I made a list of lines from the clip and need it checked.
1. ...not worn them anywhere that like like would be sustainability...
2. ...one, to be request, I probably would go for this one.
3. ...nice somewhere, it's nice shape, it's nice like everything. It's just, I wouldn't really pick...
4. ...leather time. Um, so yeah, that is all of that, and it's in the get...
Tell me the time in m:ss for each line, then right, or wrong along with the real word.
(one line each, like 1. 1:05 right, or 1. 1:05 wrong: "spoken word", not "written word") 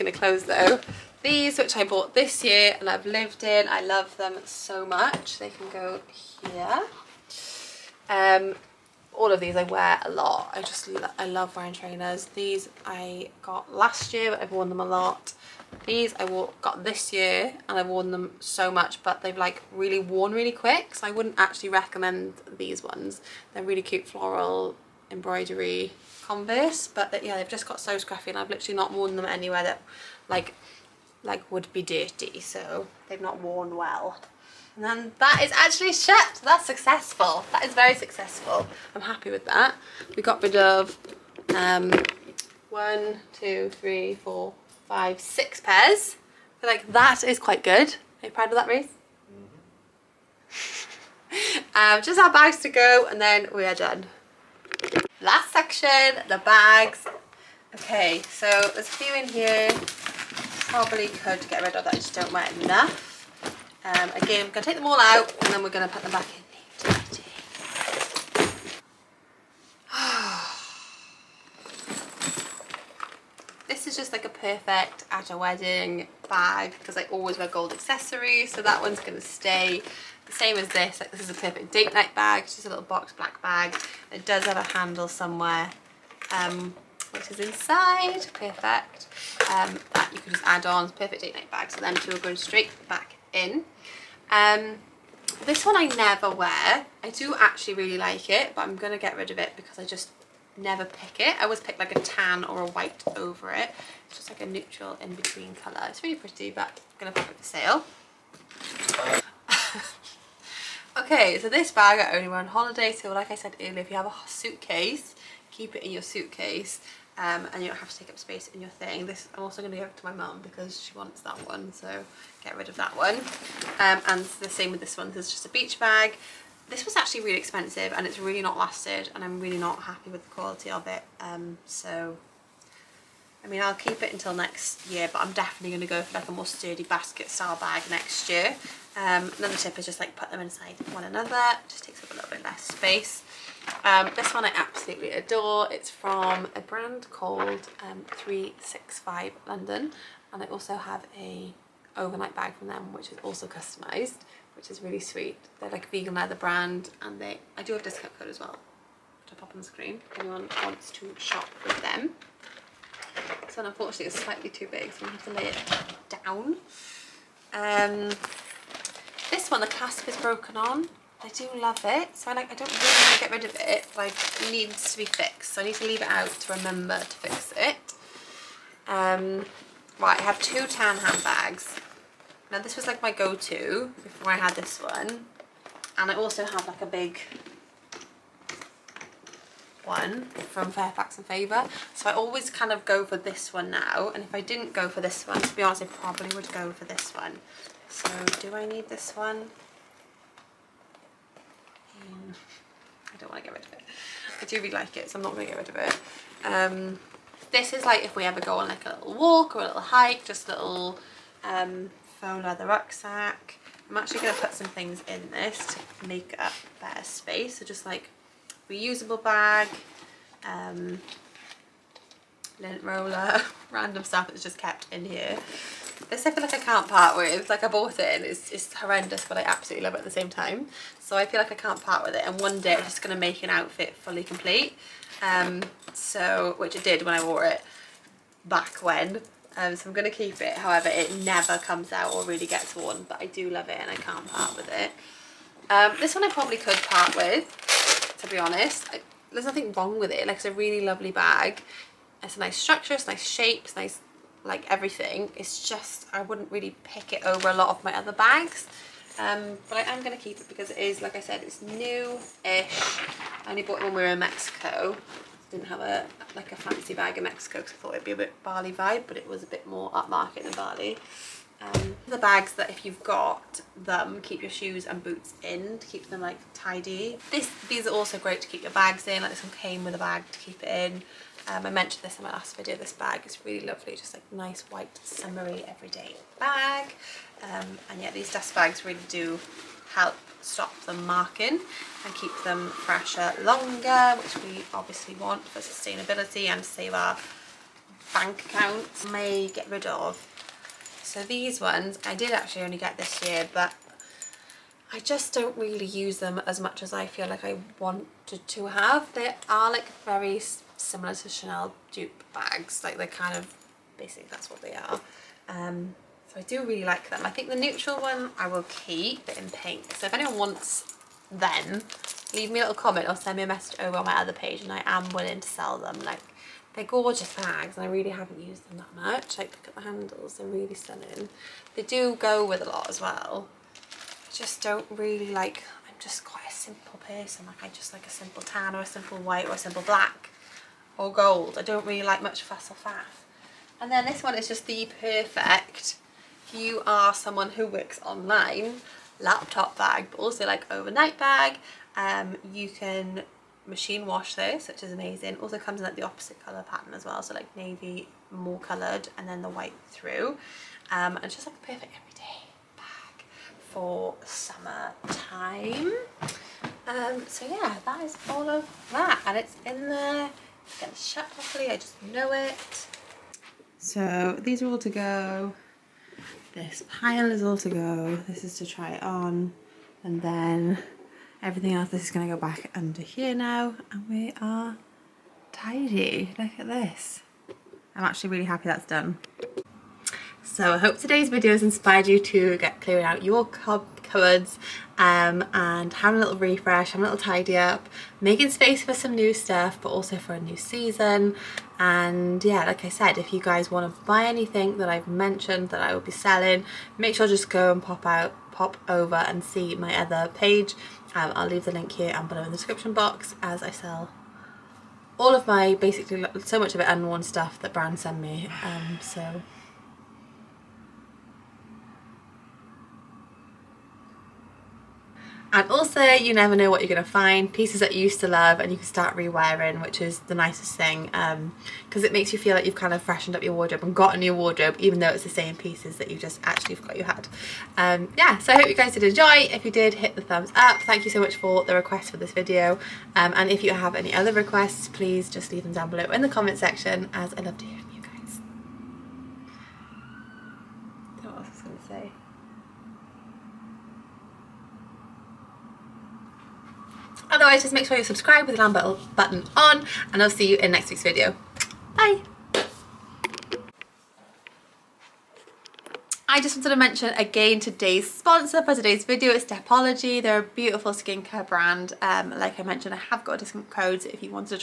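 1. 0:28 wrong: "dirty", not "sustainability"
2. 3:15 wrong: "honest", not "request"
3. 4:12 wrong: "structure", not "somewhere"
4. 6:04 wrong: "summer", not "leather".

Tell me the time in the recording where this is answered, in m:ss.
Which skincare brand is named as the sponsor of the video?
7:49.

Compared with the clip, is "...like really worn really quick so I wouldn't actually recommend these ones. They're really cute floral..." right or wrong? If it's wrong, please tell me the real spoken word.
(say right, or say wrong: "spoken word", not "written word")
right.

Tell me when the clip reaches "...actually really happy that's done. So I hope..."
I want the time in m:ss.
6:28.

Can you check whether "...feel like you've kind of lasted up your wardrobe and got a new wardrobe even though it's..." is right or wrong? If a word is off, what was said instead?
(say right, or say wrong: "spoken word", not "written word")
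wrong: "freshened", not "lasted".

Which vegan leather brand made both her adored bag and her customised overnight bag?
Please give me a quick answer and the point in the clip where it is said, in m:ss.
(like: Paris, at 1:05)
365 London, at 2:28.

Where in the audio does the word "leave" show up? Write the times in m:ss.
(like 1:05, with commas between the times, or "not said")
2:55, 5:22, 6:51, 7:25.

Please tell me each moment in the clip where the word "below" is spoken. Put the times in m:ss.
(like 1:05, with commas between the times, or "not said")
6:52, 7:25.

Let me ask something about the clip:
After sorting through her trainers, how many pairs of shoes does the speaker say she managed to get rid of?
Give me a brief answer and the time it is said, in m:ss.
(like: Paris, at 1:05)
6, at 0:45.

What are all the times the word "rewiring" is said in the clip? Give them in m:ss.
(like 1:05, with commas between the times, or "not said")
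7:09.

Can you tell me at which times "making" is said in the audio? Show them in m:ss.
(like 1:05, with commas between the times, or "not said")
6:38.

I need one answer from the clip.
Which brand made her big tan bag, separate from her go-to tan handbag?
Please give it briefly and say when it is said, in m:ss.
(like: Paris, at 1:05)
Fairfax and Favour, at 3:10.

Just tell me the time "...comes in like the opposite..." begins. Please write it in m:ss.
5:55.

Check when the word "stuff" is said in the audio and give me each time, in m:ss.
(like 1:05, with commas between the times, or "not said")
3:44, 6:39, 6:57.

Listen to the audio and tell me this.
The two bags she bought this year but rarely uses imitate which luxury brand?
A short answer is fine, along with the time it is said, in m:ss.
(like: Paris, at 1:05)
Chanel, at 5:11.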